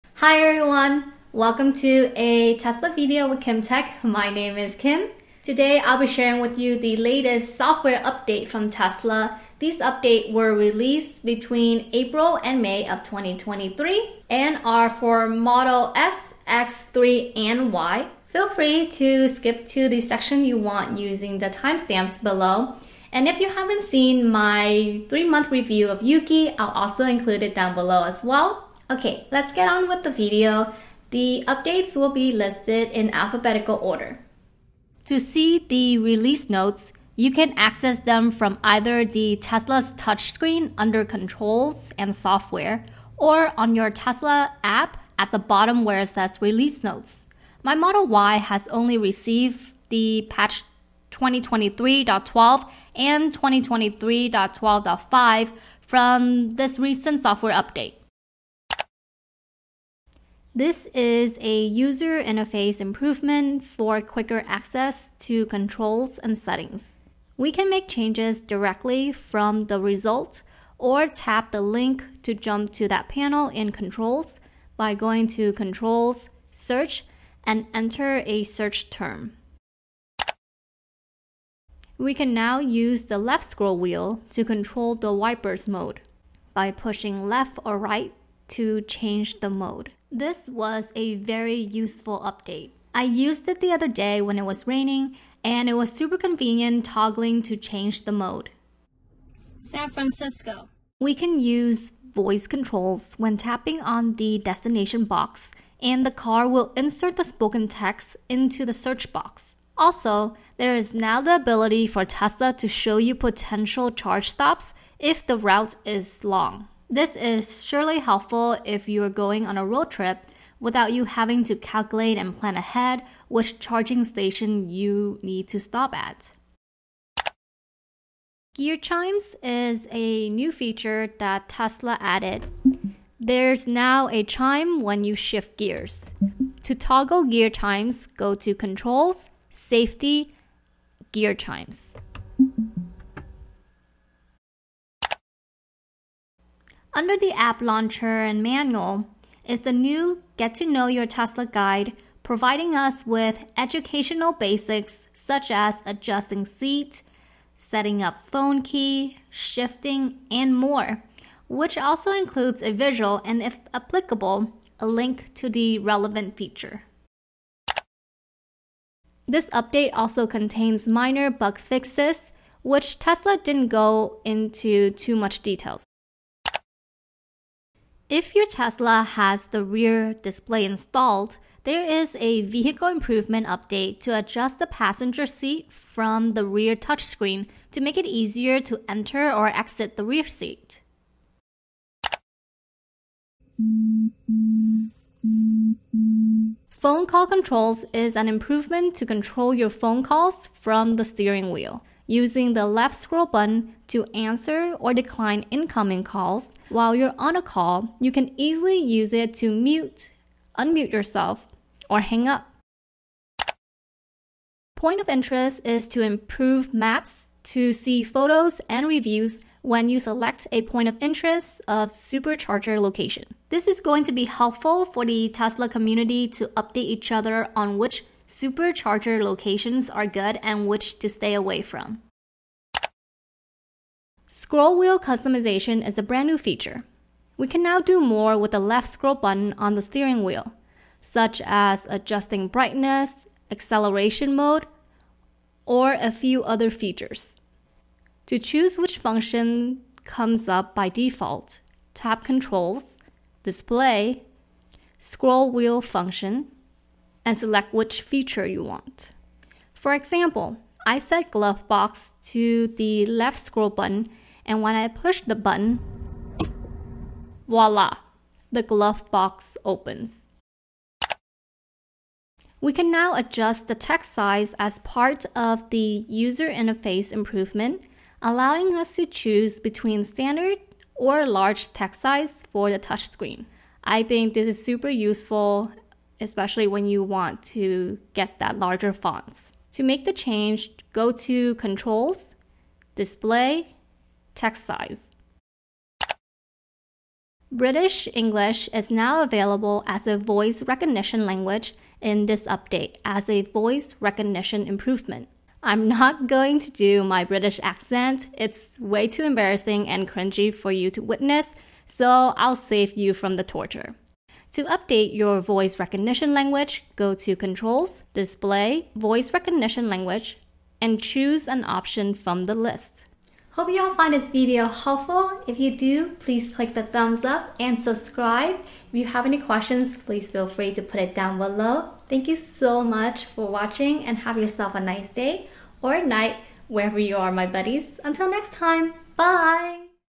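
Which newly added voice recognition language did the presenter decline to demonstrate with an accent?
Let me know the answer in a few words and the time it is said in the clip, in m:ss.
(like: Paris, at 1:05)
British English, at 4:57.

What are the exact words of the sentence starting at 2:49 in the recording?
This update also contains minor bug fixes, which Tesla didn't go into too much details.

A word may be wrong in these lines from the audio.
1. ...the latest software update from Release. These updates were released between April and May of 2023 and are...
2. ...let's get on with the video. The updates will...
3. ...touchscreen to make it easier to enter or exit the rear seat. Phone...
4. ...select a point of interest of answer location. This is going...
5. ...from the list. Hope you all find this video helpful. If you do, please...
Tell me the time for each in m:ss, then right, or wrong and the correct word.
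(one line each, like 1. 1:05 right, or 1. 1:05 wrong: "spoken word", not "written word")
1. 0:06 wrong: "Tesla", not "Release"
2. 0:29 right
3. 3:06 right
4. 3:39 wrong: "supercharger", not "answer"
5. 5:22 right.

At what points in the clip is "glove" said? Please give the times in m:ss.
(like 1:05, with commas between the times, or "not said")
4:21, 4:28.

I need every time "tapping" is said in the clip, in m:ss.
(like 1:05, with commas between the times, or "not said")
1:43.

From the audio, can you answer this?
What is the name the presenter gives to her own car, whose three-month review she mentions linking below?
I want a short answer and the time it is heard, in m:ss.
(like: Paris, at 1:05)
Yuki, at 0:26.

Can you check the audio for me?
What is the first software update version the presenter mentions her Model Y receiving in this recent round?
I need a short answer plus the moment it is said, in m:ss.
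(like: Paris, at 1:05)
2023.12, at 0:51.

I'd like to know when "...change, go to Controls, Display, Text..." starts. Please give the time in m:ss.
4:50.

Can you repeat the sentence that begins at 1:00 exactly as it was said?
This is a user interface improvement for quicker access to controls and settings.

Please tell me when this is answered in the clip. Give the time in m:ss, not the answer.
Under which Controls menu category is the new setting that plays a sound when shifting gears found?
2:19.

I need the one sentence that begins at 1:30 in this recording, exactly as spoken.
This was a very useful update.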